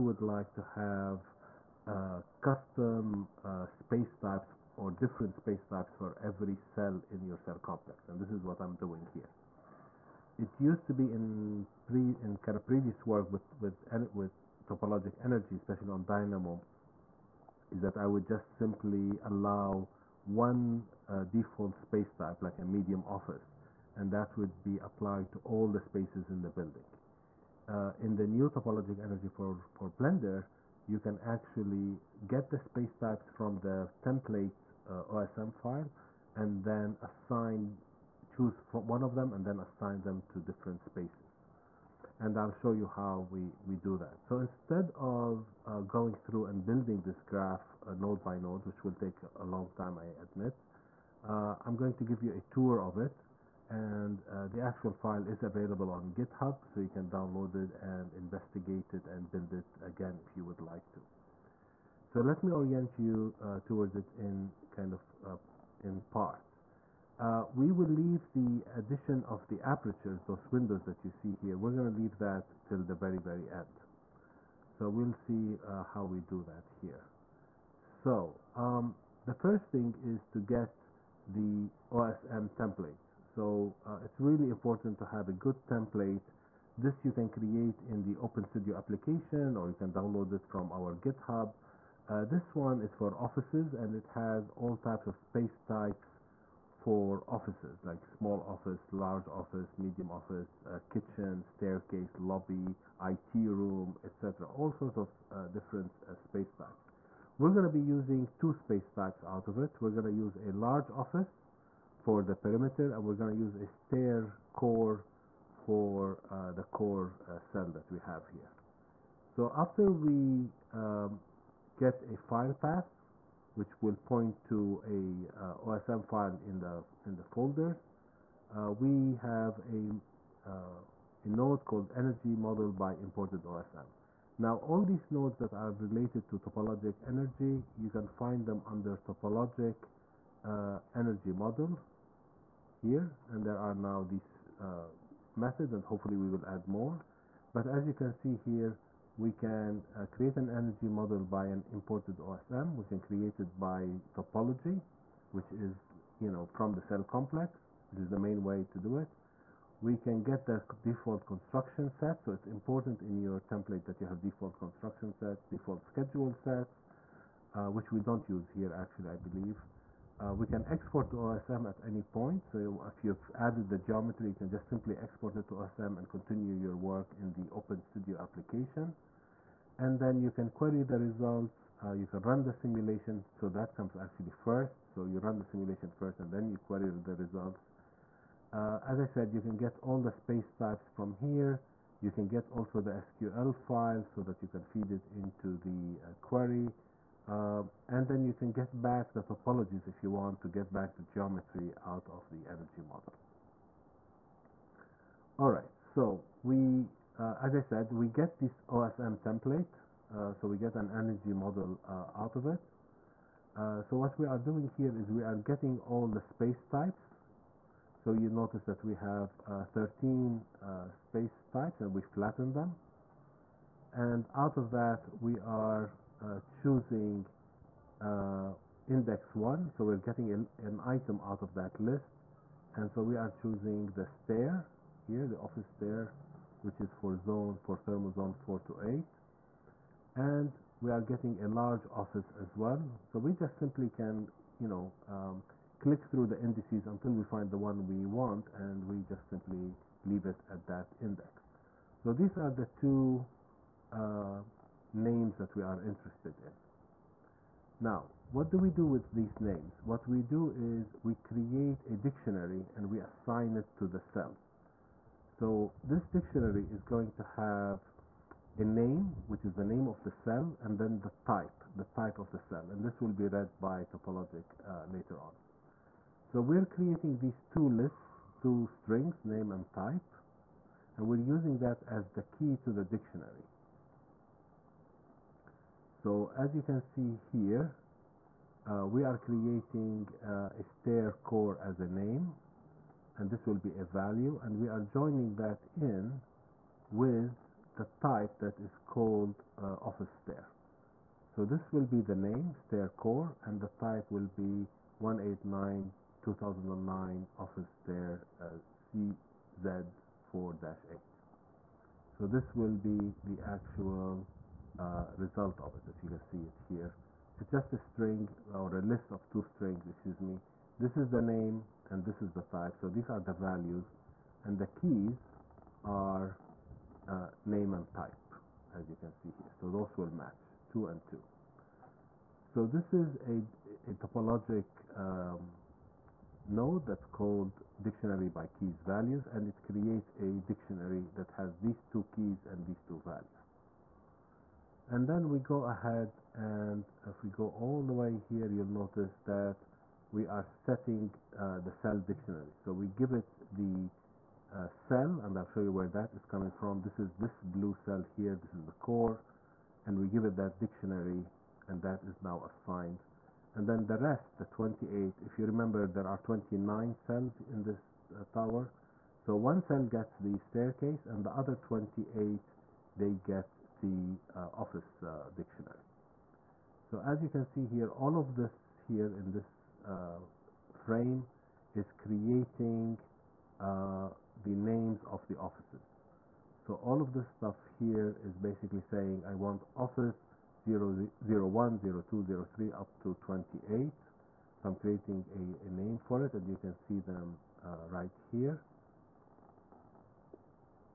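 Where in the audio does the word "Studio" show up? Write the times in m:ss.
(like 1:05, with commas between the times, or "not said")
1:28, 2:57.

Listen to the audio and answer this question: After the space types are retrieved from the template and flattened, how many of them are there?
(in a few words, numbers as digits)
13.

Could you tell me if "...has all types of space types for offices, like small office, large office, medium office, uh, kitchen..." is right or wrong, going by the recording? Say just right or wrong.
right.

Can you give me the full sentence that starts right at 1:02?
So let me orient you uh, towards it in kind of uh, in parts.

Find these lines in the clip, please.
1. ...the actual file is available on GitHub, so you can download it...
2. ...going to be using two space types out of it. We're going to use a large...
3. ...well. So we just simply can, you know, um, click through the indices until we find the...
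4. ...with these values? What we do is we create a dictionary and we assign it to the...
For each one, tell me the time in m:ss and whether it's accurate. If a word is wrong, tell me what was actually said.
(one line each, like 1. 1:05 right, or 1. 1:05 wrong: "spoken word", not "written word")
1. 0:54 right
2. 1:47 right
3. 4:02 right
4. 4:18 wrong: "names", not "values".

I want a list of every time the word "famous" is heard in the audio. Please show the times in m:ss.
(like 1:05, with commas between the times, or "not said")
not said.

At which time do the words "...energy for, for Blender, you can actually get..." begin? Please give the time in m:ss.
0:29.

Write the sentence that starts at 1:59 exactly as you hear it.
So after we um, get a file path, which will point to a uh, OSM file in the in the folders.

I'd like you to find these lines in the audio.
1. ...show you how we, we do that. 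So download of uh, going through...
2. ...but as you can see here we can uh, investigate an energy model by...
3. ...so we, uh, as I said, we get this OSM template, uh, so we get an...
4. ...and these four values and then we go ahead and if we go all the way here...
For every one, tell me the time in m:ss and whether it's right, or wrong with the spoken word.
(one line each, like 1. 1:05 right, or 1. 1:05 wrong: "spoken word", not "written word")
1. 0:42 wrong: "instead", not "download"
2. 2:27 wrong: "create", not "investigate"
3. 3:25 right
4. 5:42 wrong: "two", not "four".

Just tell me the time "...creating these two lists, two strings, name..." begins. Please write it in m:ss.
4:36.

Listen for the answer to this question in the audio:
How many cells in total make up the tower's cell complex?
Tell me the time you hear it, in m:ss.
6:06.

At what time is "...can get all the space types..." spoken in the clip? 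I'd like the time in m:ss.
3:09.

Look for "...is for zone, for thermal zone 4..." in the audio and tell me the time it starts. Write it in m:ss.
3:56.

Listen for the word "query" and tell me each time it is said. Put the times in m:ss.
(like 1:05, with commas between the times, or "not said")
3:00, 3:06, 3:16.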